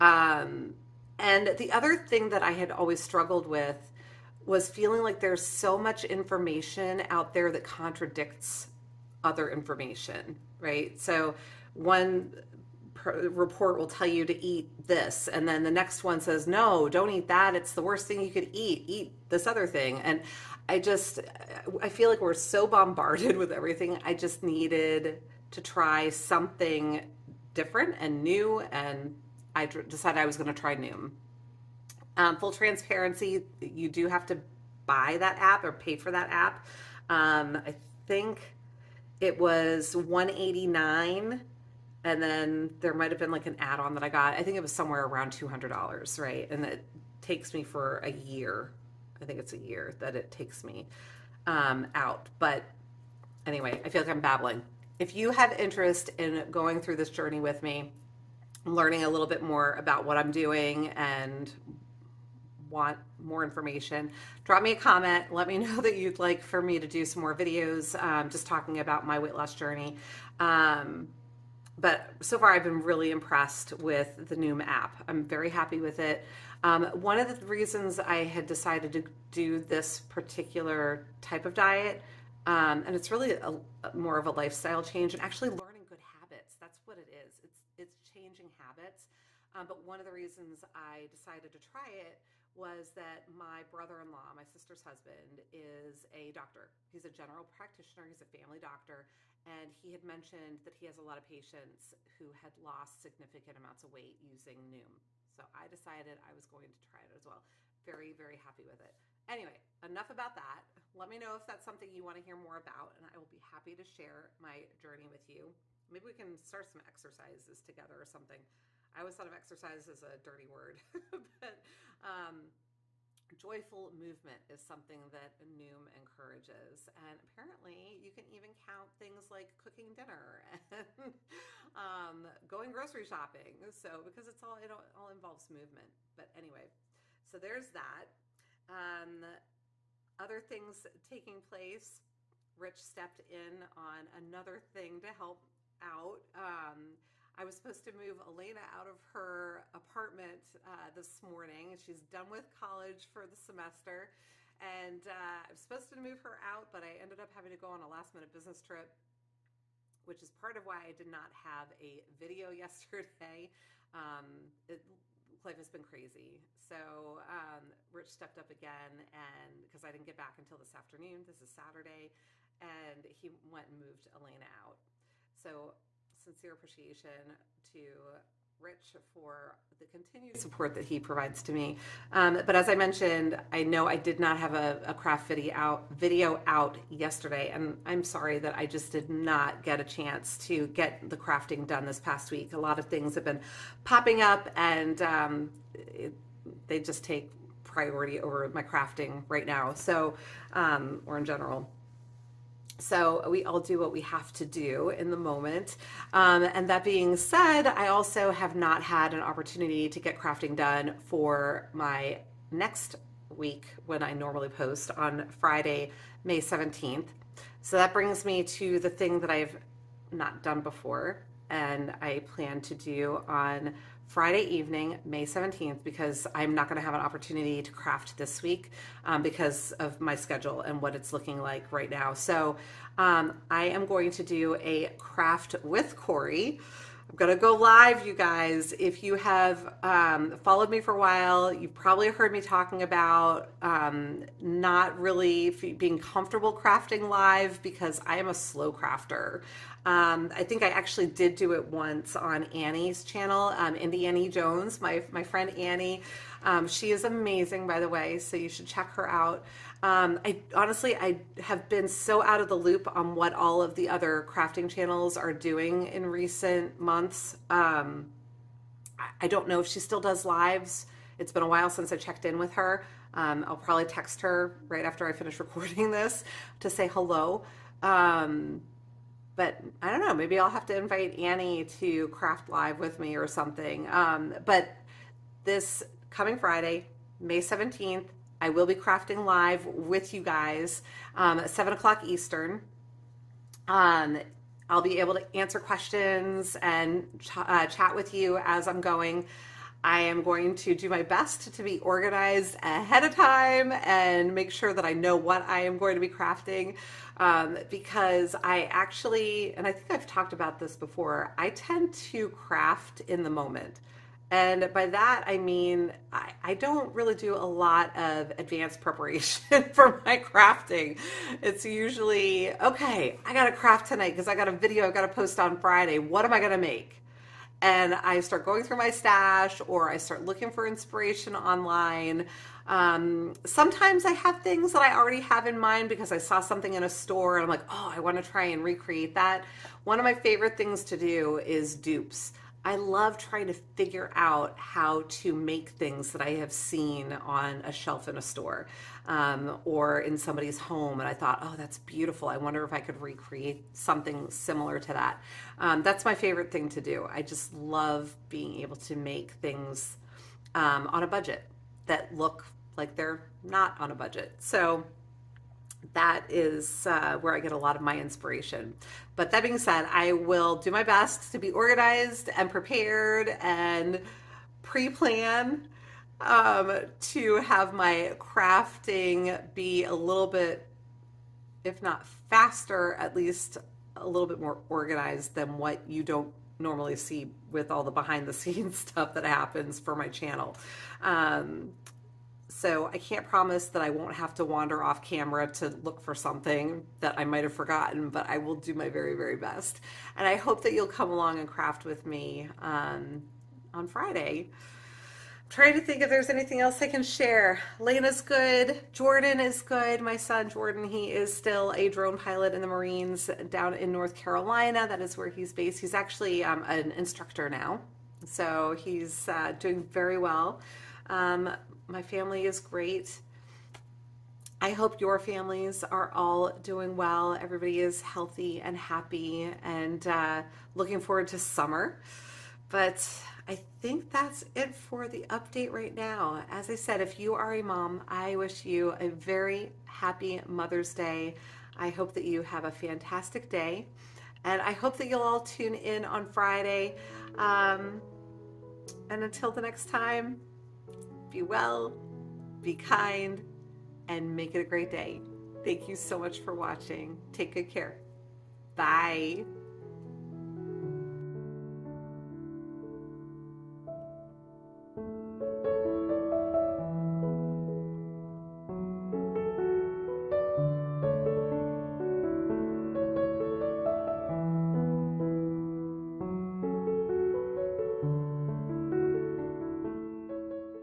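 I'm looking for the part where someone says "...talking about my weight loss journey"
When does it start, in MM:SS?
01:08.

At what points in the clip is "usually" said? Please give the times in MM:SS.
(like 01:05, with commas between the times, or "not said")
05:21.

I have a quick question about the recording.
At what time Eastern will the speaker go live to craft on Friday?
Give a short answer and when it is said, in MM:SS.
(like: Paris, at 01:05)
7 o'clock, at 04:51.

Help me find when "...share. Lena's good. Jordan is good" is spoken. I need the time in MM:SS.
06:47.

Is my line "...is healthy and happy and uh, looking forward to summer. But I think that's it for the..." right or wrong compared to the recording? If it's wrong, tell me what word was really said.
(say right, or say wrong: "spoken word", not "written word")
right.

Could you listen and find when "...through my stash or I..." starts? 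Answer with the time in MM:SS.
05:28.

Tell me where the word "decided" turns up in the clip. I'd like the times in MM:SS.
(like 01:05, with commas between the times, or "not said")
00:29, 01:18, 01:31, 01:45.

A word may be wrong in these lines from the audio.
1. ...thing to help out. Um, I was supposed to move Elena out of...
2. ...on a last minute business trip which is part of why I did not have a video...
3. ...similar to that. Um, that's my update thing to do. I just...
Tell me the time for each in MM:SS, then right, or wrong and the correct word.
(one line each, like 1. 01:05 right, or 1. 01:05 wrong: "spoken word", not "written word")
1. 02:24 right
2. 02:37 right
3. 05:54 wrong: "favorite", not "update".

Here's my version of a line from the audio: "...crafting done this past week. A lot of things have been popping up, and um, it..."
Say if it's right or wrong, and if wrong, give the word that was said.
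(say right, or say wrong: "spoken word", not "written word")
right.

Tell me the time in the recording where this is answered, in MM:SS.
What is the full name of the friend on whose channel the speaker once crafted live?
04:13.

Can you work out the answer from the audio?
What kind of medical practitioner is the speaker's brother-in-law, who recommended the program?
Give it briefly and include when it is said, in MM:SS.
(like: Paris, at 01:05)
General practitioner, at 01:37.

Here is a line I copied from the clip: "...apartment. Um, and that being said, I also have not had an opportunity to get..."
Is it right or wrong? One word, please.
wrong.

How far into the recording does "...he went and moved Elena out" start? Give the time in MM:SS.
02:53.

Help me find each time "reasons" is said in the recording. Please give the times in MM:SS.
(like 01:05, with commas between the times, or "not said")
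01:17, 01:30.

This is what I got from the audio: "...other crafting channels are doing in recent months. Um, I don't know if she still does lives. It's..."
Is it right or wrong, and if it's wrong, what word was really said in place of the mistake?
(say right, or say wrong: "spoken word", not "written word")
right.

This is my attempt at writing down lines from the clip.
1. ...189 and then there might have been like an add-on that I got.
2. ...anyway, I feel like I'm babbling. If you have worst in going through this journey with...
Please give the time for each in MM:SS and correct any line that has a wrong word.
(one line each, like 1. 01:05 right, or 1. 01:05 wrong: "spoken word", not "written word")
1. 00:39 right
2. 00:53 wrong: "interest", not "worst".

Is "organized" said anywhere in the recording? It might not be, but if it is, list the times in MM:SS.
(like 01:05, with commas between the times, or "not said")
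05:01, 06:11, 06:24.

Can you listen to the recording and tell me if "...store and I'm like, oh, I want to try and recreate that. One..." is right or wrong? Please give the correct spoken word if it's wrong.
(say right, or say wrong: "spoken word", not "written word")
right.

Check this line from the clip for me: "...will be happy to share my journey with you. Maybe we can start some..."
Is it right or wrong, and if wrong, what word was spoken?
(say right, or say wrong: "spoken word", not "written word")
right.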